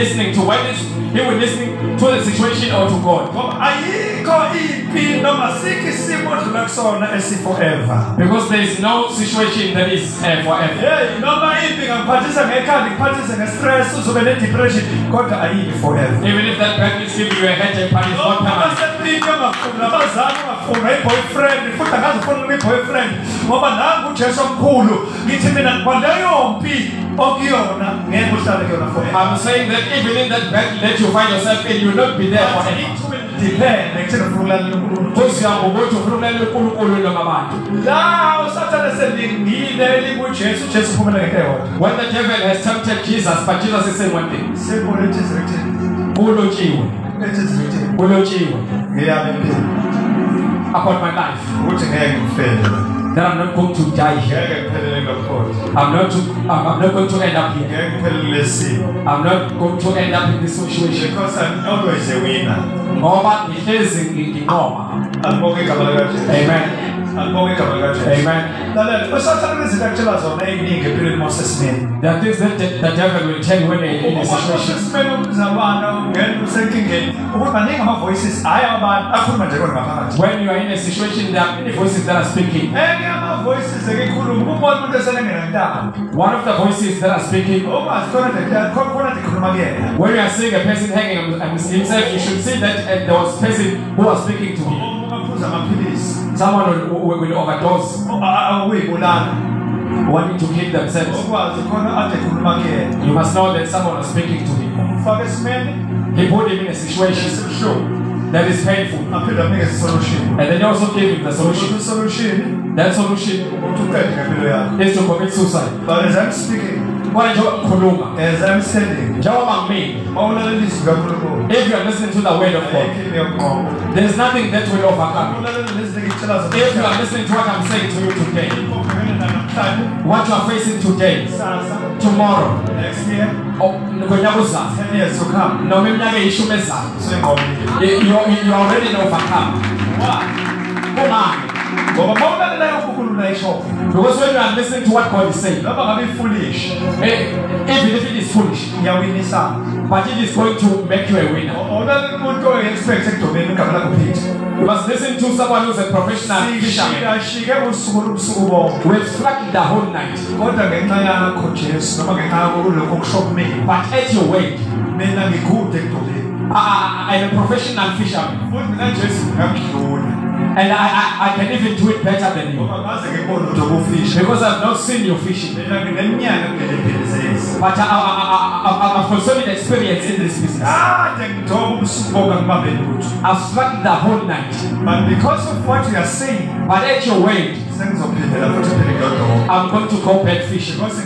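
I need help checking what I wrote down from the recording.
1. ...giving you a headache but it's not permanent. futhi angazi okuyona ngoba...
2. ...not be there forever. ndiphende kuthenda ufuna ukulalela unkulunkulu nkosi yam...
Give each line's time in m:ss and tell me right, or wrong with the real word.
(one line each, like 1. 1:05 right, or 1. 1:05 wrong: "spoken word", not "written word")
1. 0:17 wrong: "ufuna", not "okuyona"
2. 0:32 right.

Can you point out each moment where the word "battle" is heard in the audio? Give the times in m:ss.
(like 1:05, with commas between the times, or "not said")
0:30.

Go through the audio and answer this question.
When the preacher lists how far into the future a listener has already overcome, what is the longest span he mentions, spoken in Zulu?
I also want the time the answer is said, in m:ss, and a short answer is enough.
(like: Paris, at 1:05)
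10 years, at 2:15.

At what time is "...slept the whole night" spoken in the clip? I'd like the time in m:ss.
3:03.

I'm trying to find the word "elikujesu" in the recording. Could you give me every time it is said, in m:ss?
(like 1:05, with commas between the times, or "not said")
0:39.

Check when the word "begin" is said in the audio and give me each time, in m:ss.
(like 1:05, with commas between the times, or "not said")
not said.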